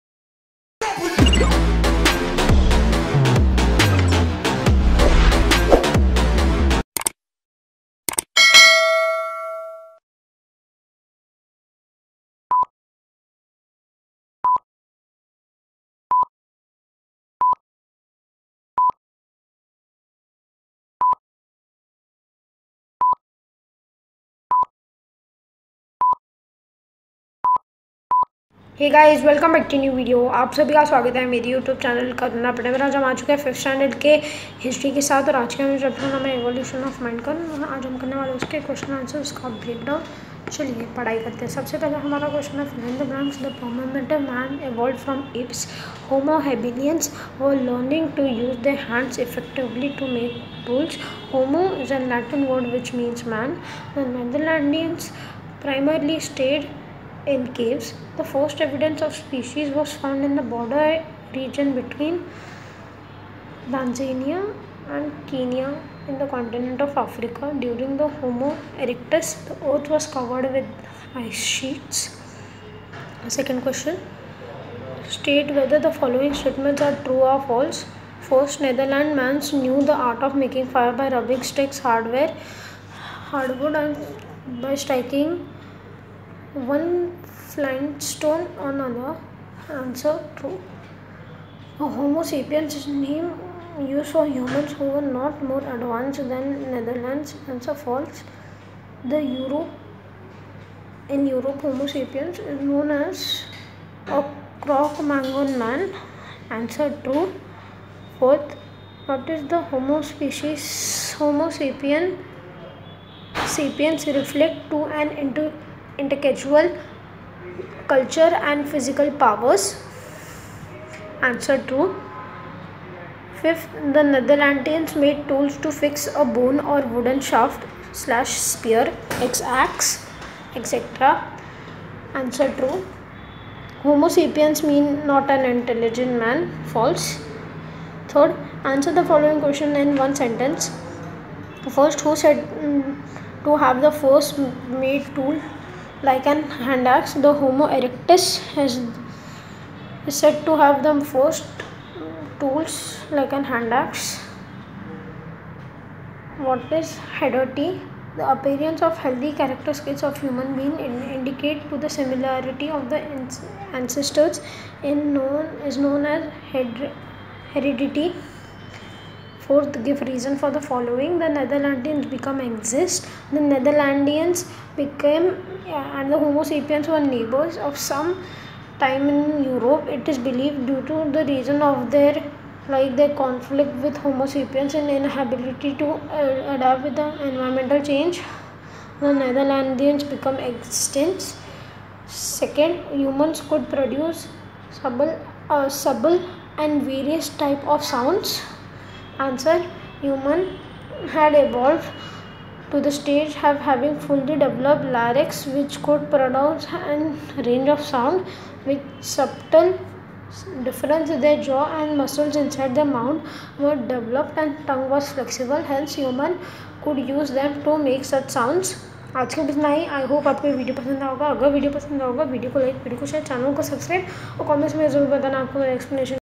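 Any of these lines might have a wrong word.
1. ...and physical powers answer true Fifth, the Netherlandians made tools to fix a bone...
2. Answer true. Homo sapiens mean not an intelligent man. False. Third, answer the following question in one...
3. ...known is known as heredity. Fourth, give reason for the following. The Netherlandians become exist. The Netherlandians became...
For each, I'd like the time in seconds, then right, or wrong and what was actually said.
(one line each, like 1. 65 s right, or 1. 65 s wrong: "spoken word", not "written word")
1. 118 s right
2. 132 s right
3. 165 s right.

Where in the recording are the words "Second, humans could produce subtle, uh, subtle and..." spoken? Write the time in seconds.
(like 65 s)
192 s.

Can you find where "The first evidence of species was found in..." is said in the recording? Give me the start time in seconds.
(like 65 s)
58 s.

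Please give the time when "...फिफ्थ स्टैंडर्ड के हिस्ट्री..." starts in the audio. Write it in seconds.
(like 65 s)
33 s.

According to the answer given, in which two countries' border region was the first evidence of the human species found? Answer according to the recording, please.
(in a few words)
Tanzania and Kenya.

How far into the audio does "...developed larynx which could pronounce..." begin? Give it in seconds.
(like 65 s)
204 s.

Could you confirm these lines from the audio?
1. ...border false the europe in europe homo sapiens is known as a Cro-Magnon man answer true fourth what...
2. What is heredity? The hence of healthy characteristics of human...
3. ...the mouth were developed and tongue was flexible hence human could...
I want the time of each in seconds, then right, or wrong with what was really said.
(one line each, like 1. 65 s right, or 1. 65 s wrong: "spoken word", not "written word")
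1. 97 s wrong: "answer", not "border"
2. 156 s wrong: "appearance", not "hence"
3. 212 s right.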